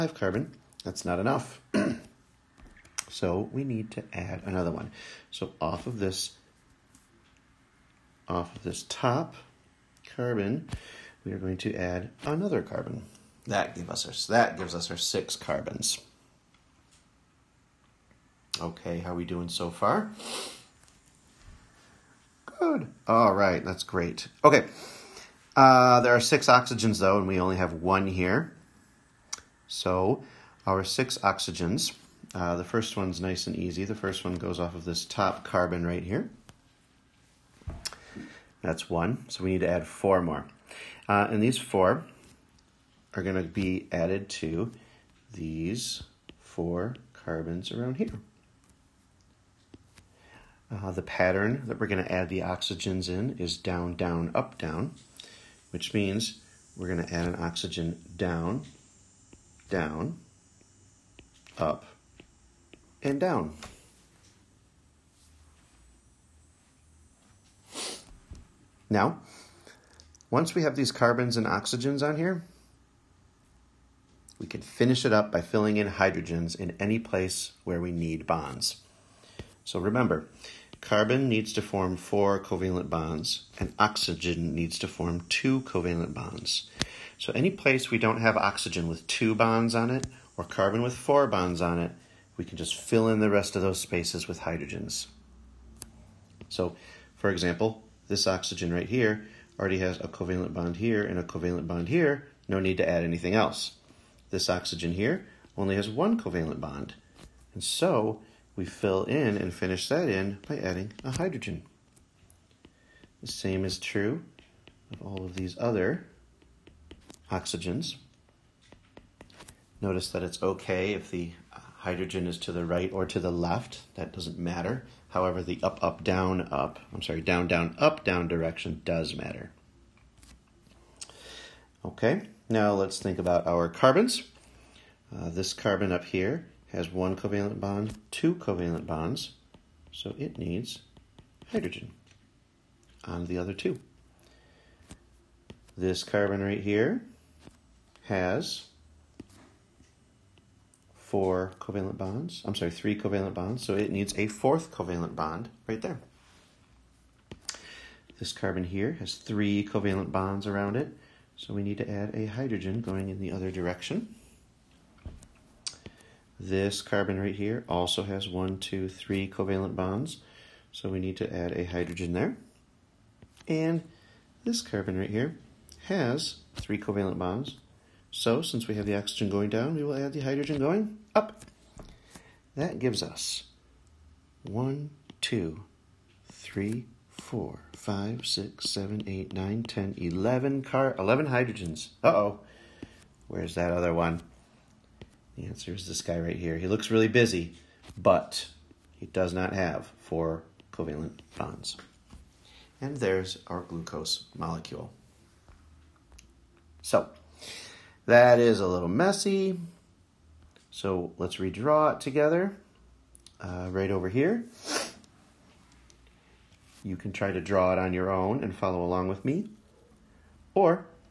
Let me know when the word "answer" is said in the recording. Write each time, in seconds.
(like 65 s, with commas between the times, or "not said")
195 s.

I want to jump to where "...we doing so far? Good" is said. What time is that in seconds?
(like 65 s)
19 s.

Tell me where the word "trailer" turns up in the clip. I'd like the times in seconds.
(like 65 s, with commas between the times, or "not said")
not said.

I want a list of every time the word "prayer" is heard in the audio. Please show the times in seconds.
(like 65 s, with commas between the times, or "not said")
not said.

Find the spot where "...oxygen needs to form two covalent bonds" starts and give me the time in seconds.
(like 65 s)
83 s.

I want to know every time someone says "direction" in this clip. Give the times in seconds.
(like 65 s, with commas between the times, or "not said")
128 s, 163 s.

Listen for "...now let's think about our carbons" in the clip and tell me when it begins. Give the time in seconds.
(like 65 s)
132 s.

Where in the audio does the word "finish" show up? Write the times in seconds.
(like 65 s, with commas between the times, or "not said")
74 s, 109 s.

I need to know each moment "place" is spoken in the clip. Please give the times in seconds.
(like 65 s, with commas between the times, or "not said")
76 s, 87 s.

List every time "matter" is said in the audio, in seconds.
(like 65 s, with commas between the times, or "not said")
124 s, 129 s.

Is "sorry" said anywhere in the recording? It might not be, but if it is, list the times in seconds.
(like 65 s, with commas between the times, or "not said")
127 s, 152 s.